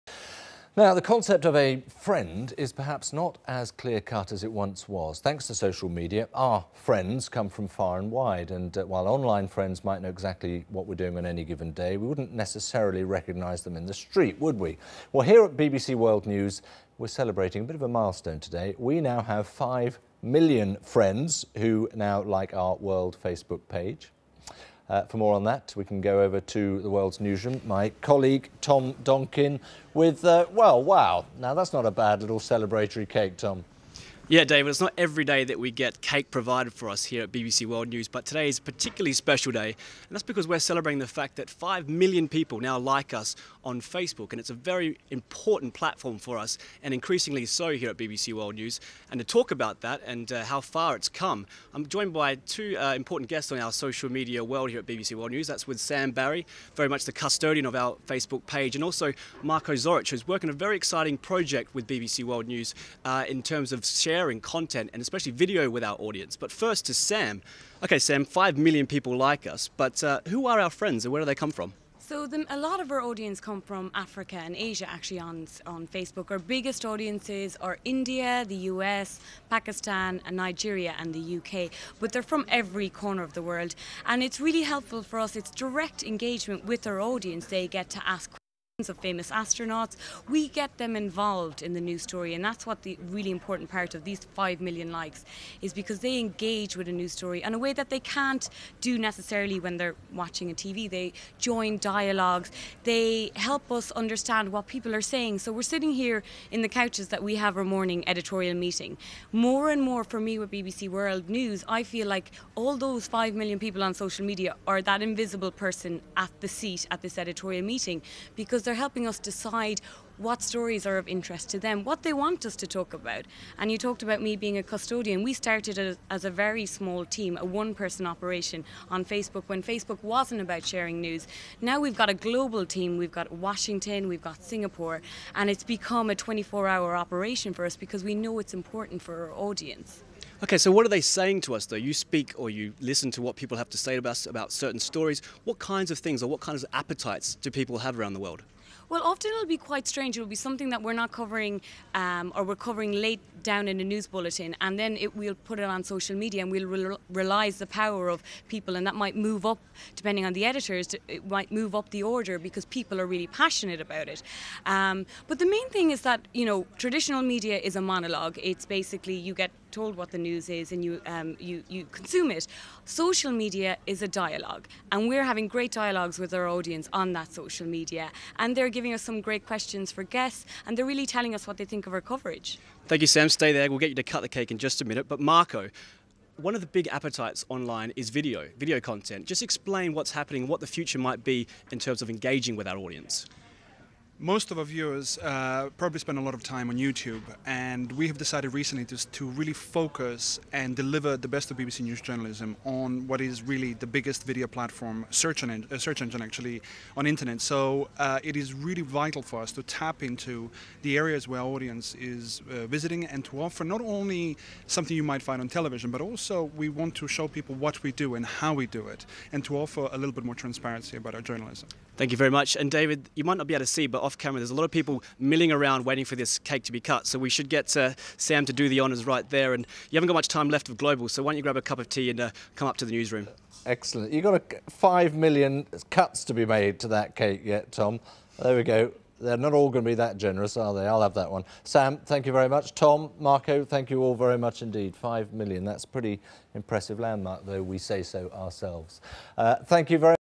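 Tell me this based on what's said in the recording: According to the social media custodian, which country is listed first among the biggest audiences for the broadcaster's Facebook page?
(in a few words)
India.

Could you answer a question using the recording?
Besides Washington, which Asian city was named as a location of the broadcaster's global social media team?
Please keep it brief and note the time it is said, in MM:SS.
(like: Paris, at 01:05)
Singapore, at 02:14.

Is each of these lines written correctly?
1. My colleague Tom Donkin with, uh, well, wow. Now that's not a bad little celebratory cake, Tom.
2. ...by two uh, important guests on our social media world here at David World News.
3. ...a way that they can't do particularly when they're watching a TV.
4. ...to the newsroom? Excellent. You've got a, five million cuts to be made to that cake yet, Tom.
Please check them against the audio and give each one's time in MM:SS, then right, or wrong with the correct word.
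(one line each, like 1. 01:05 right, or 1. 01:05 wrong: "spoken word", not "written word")
1. 00:27 right
2. 00:52 wrong: "BBC", not "David"
3. 01:37 wrong: "necessarily", not "particularly"
4. 03:52 right.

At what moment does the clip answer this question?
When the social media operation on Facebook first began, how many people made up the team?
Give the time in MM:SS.
02:07.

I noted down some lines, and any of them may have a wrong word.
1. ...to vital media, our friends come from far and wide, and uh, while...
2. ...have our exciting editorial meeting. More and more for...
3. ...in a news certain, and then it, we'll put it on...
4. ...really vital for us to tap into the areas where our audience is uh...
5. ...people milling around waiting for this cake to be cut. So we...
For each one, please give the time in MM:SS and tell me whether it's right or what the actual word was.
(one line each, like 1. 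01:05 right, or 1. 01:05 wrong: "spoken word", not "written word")
1. 00:05 wrong: "social", not "vital"
2. 01:47 wrong: "morning", not "exciting"
3. 02:33 wrong: "bulletin", not "certain"
4. 03:28 right
5. 03:44 right.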